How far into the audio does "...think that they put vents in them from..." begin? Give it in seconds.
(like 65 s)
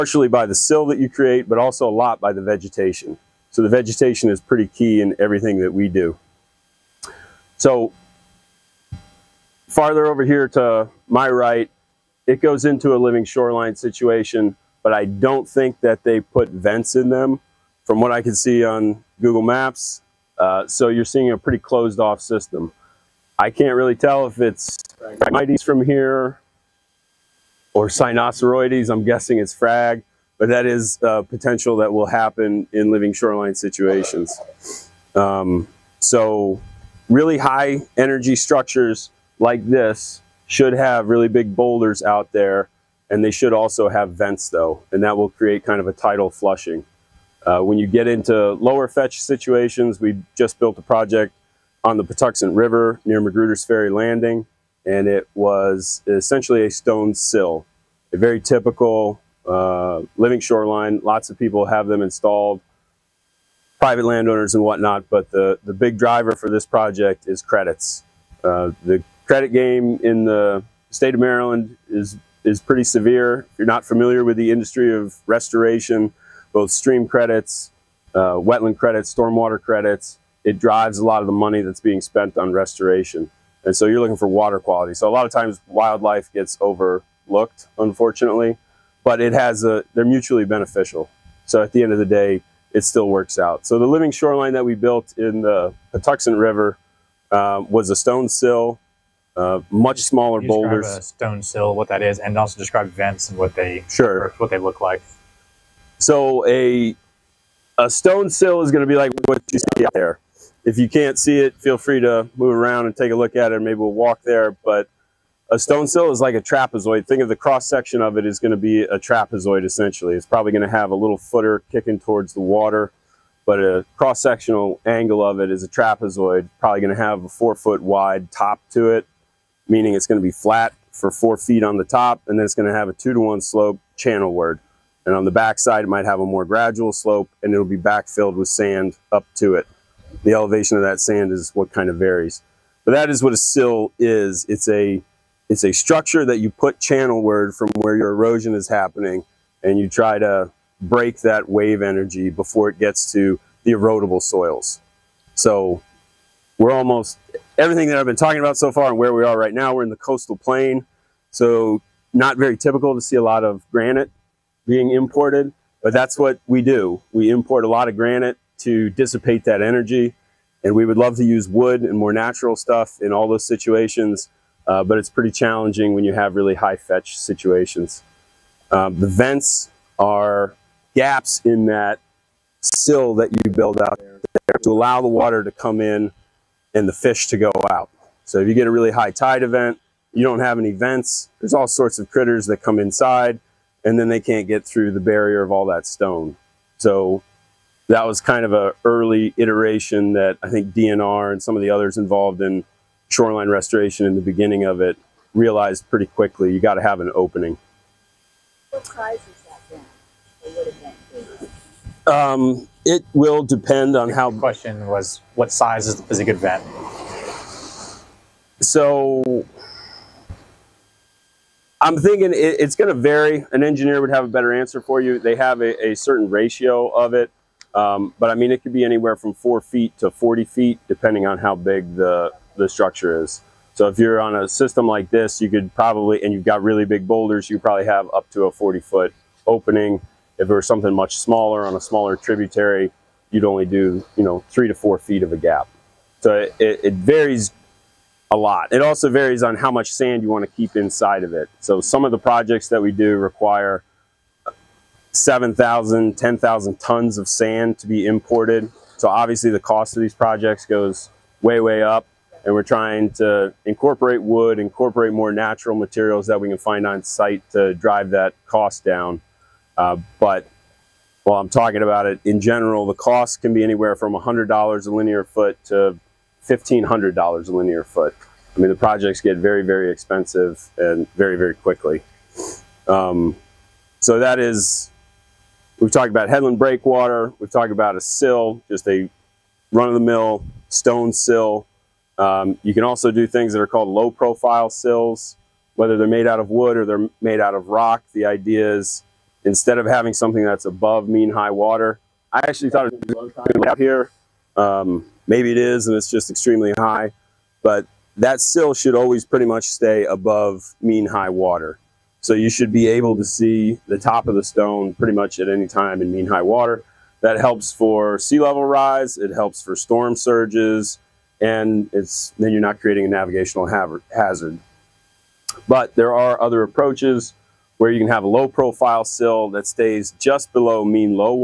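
15 s.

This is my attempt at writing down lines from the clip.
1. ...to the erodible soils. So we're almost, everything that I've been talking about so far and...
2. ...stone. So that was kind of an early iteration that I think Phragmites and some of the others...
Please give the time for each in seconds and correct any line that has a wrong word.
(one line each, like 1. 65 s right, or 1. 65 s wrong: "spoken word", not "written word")
1. 153 s right
2. 195 s wrong: "DNR", not "Phragmites".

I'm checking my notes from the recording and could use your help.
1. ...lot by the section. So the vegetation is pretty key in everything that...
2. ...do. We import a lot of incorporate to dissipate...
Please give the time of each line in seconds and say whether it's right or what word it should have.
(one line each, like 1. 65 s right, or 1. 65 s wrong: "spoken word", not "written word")
1. 1 s wrong: "vegetation", not "section"
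2. 166 s wrong: "granite", not "incorporate".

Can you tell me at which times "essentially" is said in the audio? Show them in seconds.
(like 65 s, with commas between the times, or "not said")
56 s, 119 s.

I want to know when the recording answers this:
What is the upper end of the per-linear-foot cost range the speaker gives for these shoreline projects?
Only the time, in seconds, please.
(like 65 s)
276 s.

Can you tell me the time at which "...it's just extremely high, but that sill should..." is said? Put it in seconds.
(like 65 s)
305 s.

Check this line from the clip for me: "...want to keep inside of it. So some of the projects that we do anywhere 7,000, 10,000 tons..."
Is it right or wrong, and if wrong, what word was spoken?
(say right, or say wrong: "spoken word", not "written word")
wrong: "require", not "anywhere".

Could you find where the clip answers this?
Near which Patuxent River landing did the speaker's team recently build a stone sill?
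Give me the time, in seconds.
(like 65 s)
53 s.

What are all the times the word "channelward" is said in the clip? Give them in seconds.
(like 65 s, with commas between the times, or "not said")
133 s, 146 s.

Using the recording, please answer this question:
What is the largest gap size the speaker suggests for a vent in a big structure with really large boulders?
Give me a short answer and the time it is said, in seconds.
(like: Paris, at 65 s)
40 feet, at 238 s.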